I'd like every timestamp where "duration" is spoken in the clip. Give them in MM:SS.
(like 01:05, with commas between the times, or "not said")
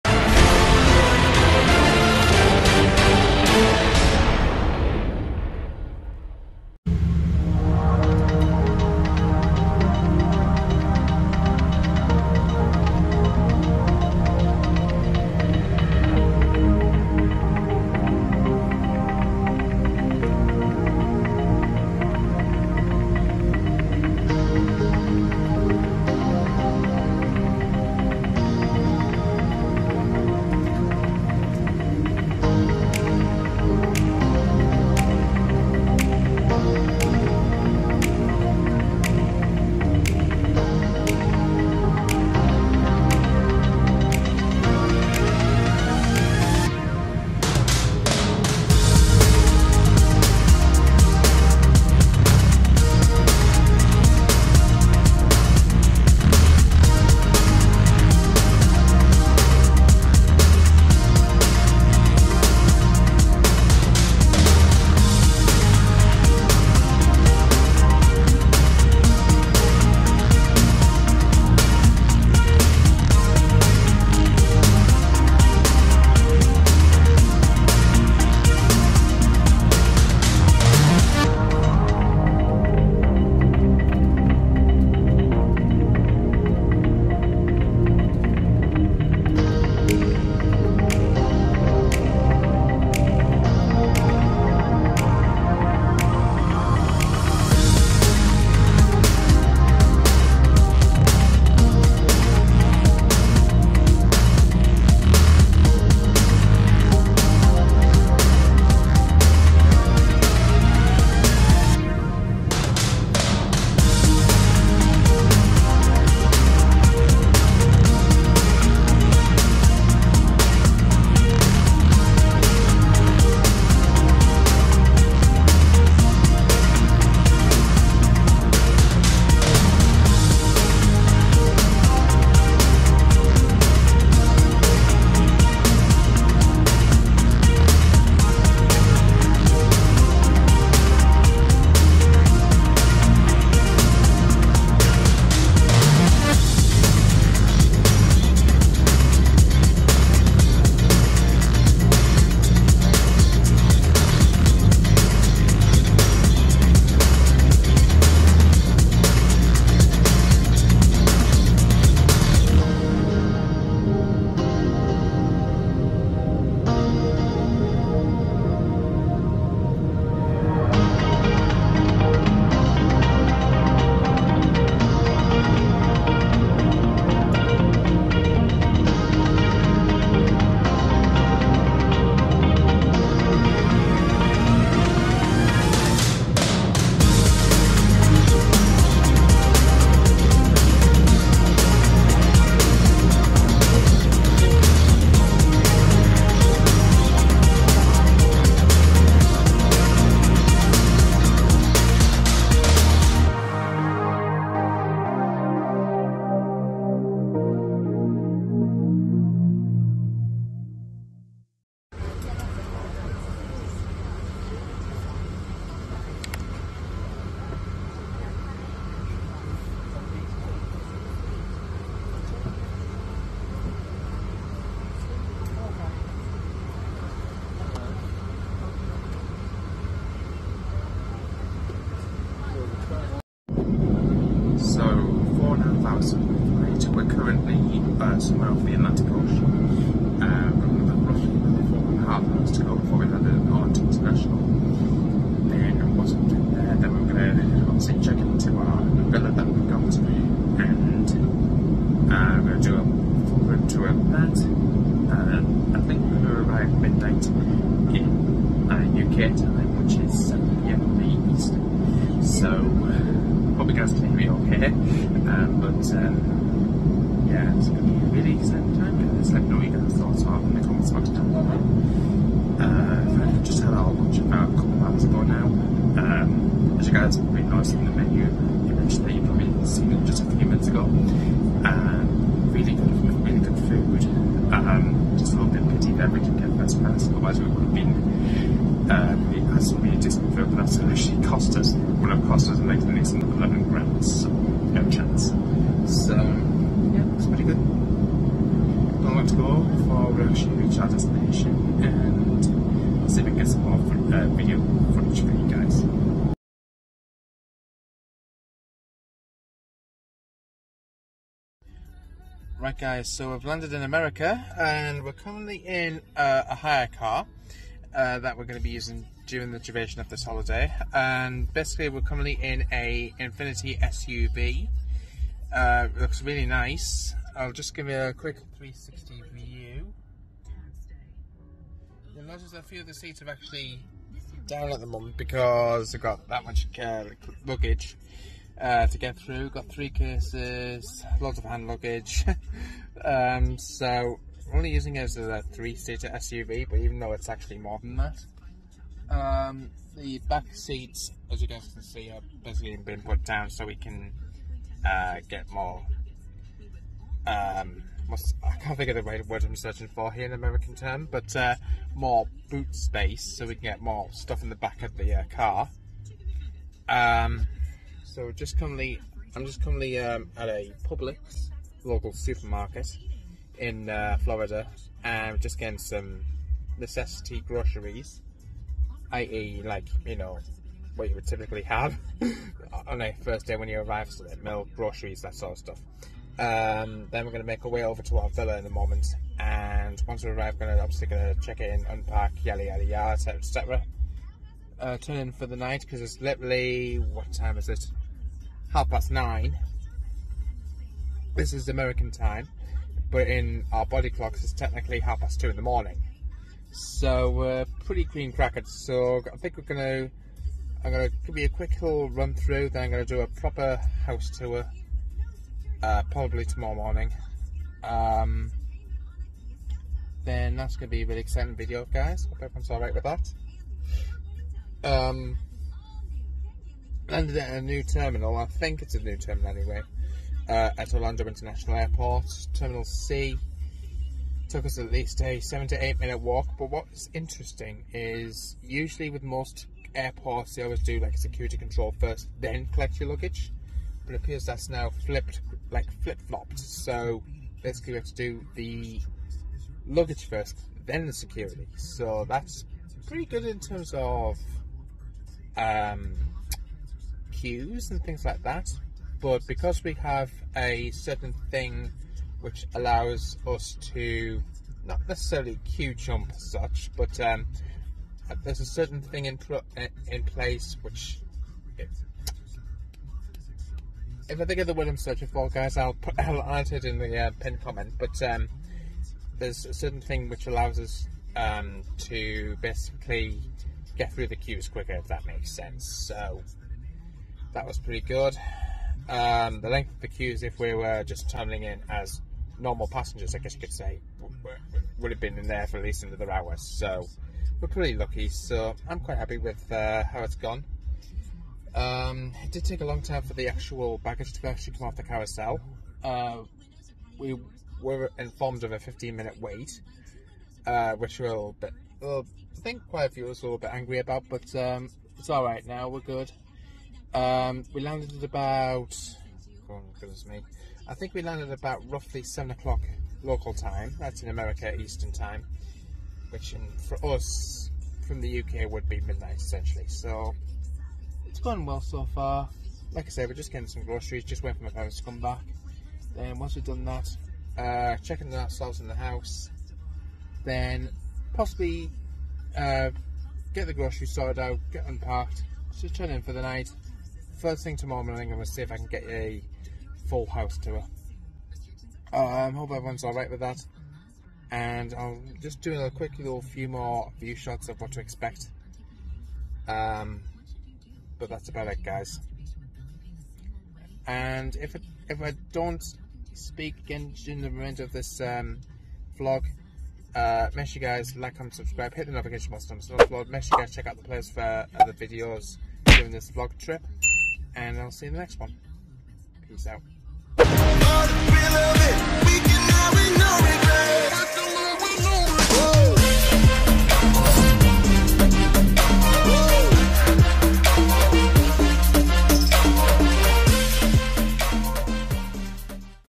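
05:19.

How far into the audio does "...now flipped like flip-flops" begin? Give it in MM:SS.
07:24.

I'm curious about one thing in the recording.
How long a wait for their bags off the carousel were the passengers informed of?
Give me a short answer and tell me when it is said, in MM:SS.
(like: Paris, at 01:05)
15 minutes, at 08:28.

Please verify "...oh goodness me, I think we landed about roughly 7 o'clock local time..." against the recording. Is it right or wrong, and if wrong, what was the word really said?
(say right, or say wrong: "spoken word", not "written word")
right.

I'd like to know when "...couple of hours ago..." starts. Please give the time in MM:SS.
04:34.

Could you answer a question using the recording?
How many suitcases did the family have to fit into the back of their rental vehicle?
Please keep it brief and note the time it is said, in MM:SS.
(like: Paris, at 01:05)
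3, at 05:39.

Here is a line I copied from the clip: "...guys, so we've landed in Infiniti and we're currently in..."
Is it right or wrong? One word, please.
wrong.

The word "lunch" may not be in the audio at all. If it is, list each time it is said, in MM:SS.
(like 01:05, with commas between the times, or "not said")
04:33.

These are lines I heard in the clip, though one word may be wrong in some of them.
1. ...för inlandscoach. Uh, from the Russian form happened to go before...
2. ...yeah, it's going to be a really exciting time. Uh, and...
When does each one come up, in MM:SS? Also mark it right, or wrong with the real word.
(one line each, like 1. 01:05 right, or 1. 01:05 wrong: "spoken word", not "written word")
1. 03:58 right
2. 04:27 right.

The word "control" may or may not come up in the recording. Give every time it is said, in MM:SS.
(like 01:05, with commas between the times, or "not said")
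07:21.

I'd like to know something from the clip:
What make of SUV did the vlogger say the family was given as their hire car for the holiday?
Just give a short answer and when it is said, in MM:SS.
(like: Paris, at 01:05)
Infiniti, at 05:23.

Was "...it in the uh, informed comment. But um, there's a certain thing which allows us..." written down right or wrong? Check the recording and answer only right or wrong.
wrong.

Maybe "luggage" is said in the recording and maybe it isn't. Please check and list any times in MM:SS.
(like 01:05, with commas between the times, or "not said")
05:37, 05:41, 07:23, 07:29.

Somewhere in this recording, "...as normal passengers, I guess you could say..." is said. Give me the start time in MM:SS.
08:11.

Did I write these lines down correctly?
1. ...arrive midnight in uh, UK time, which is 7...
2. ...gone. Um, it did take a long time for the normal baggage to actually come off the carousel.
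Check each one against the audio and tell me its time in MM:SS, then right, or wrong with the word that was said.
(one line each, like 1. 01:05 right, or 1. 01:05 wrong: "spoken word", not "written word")
1. 04:16 right
2. 08:20 wrong: "actual", not "normal".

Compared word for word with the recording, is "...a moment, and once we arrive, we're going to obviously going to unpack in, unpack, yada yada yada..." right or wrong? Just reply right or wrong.
wrong.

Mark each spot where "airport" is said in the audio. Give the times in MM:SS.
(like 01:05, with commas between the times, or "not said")
07:11, 07:19.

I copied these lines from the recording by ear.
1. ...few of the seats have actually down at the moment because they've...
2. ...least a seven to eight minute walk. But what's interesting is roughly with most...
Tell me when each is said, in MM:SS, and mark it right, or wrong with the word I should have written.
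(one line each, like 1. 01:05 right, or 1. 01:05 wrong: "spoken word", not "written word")
1. 05:32 right
2. 07:14 wrong: "usually", not "roughly".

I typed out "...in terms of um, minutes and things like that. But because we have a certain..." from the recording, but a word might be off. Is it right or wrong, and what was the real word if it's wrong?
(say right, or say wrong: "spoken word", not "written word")
wrong: "queues", not "minutes".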